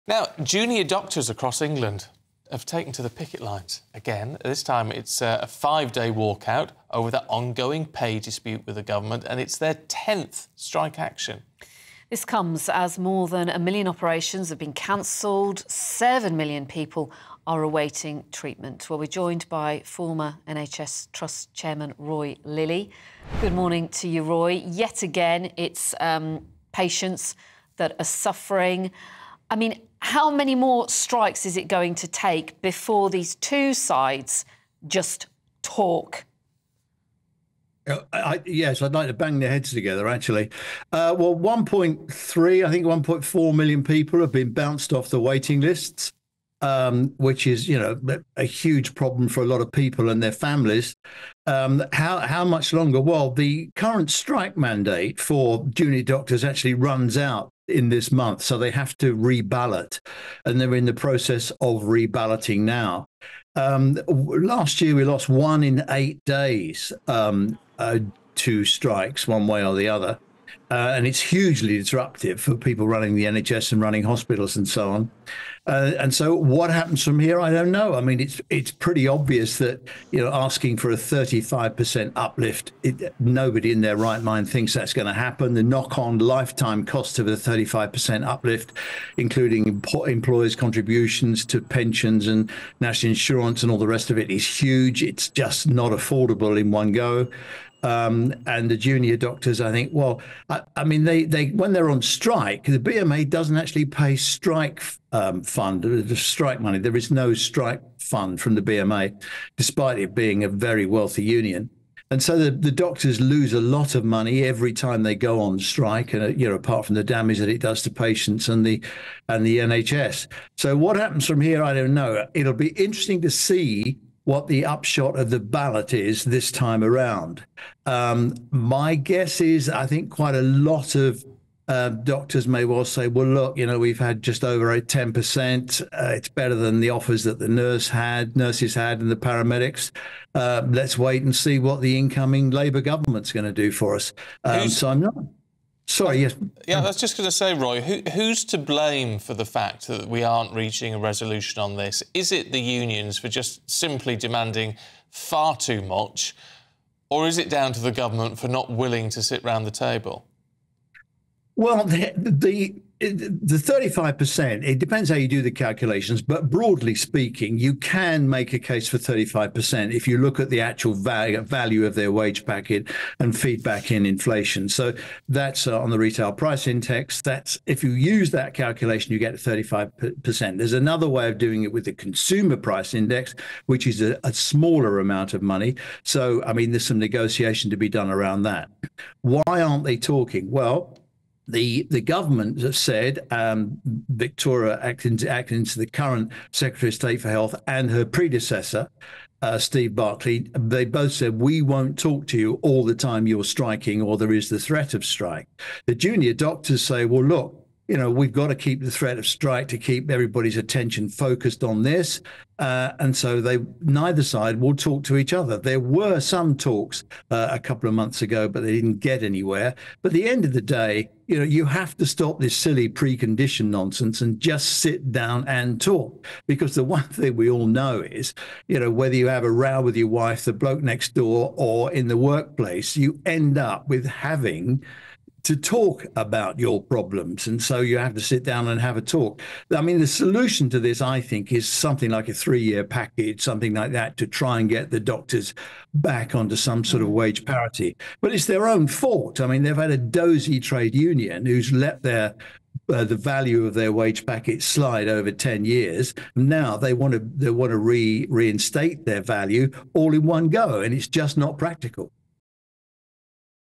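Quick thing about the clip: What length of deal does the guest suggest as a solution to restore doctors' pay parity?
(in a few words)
3 years.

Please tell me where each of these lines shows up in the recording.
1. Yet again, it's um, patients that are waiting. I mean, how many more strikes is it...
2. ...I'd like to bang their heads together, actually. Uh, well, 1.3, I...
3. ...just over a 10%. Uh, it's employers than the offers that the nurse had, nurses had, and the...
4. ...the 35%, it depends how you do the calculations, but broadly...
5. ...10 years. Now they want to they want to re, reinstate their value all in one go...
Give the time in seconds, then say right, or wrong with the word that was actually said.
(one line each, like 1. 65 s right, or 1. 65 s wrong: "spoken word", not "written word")
1. 24 s wrong: "suffering", not "waiting"
2. 38 s right
3. 134 s wrong: "better", not "employers"
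4. 163 s right
5. 255 s right.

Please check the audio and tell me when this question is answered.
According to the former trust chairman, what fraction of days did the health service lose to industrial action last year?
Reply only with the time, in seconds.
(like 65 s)
65 s.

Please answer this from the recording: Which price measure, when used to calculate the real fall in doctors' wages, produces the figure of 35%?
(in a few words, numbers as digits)
Retail price index.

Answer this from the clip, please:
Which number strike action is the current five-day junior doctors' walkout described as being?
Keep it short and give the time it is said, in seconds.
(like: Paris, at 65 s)
10th, at 9 s.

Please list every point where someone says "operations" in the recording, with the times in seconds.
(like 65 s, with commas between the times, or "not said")
13 s.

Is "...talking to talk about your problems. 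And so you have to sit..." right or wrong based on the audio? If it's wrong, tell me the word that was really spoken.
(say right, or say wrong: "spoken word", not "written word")
wrong: "having", not "talking".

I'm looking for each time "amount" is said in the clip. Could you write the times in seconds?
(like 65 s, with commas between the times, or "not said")
184 s.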